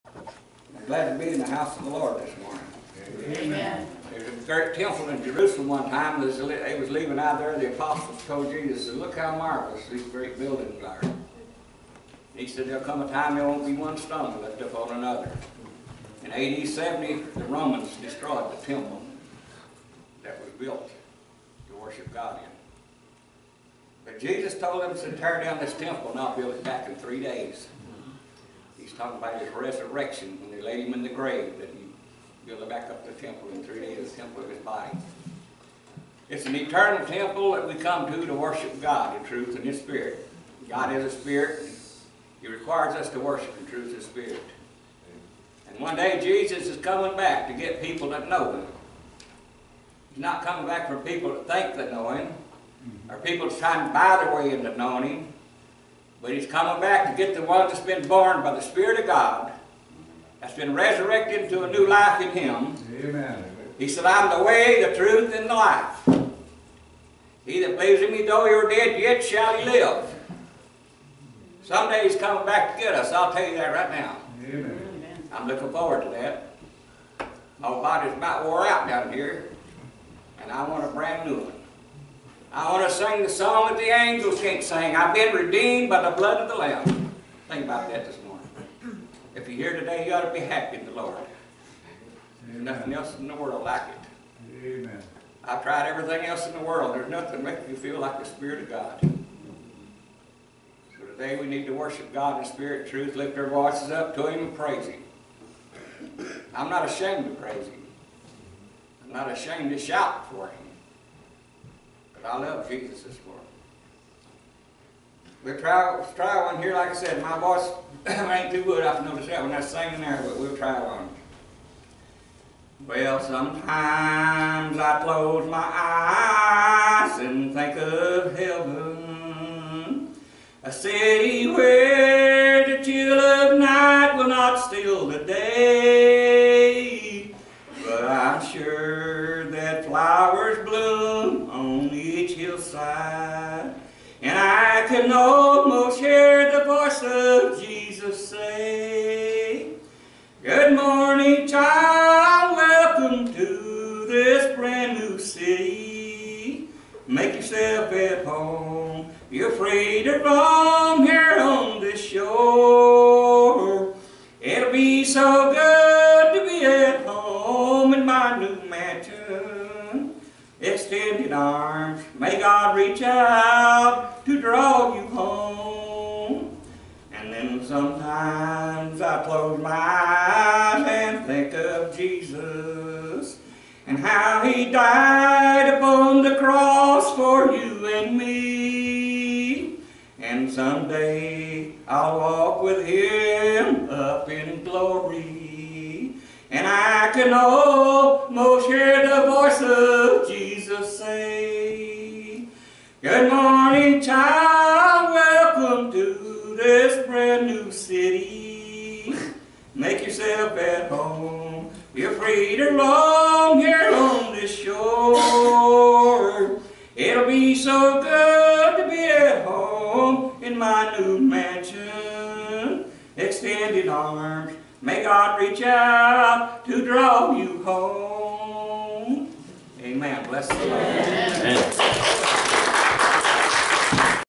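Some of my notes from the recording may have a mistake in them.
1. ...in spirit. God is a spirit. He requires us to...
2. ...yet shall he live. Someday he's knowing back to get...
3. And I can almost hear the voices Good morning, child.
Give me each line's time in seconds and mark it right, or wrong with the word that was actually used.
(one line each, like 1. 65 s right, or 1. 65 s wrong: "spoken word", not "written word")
1. 39 s right
2. 69 s wrong: "coming", not "knowing"
3. 196 s right.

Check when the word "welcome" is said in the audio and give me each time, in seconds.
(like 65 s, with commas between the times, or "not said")
152 s, 205 s.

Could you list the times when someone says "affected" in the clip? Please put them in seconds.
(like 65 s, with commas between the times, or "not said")
not said.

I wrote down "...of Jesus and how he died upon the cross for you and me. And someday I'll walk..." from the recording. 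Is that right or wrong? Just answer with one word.
right.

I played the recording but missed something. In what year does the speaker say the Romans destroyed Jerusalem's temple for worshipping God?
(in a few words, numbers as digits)
AD 70.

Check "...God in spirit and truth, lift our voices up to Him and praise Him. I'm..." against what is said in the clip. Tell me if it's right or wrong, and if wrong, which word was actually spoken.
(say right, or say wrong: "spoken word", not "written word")
right.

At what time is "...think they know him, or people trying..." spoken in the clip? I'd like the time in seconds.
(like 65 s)
51 s.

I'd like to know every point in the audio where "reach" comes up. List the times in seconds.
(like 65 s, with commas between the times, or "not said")
172 s, 225 s.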